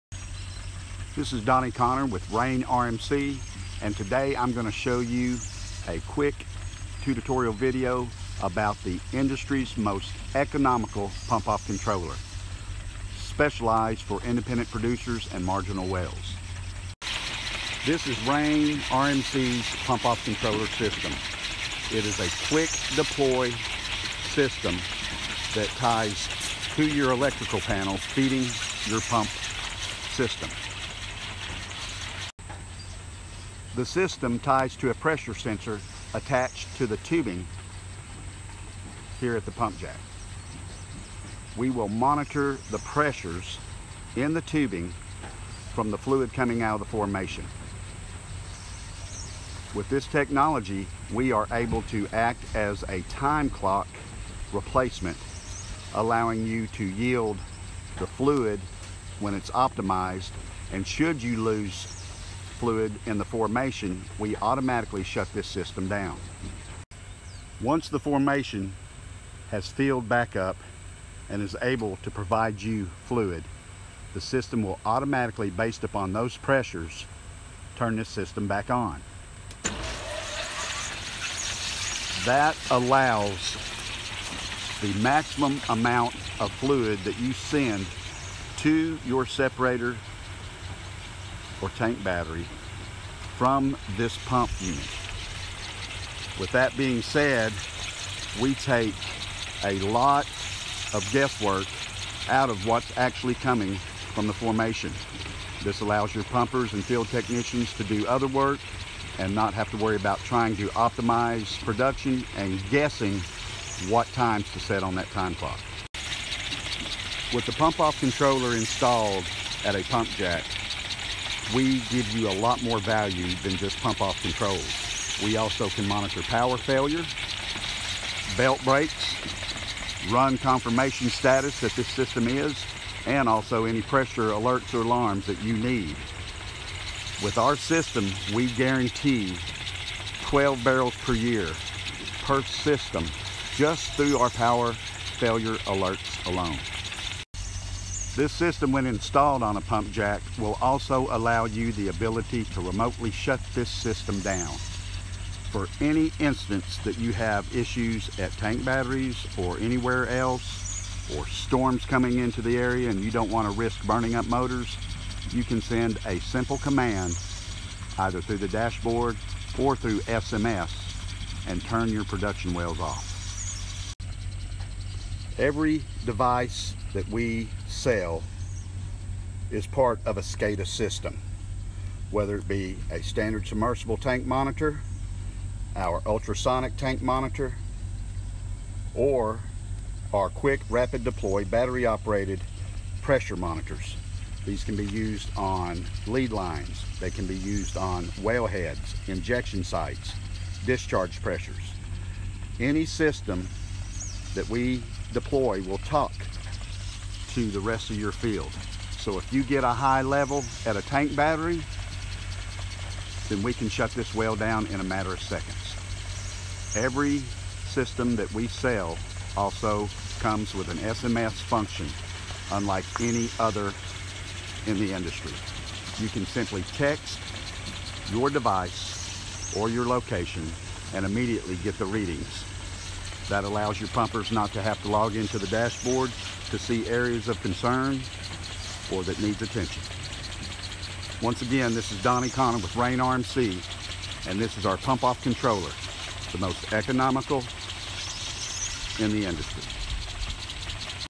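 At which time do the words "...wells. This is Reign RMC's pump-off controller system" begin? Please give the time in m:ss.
0:15.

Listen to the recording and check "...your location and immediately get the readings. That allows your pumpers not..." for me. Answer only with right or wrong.
right.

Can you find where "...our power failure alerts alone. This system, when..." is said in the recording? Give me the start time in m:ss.
2:24.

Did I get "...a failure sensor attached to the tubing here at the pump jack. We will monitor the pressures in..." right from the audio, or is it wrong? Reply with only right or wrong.
wrong.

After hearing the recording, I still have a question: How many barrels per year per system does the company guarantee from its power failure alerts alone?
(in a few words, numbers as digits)
12.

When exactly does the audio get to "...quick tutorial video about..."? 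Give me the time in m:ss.
0:06.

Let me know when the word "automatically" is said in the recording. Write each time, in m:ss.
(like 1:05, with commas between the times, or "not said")
1:04, 1:14.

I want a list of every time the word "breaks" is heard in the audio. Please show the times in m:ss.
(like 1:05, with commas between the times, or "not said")
2:08.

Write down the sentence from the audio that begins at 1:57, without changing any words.
With the pump off controller installed at a pump jack, we give you a lot more value than just pump off controls.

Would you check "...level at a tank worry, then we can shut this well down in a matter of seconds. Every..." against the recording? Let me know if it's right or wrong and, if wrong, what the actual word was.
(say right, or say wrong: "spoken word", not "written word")
wrong: "battery", not "worry".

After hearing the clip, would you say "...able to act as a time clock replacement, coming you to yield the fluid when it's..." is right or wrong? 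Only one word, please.
wrong.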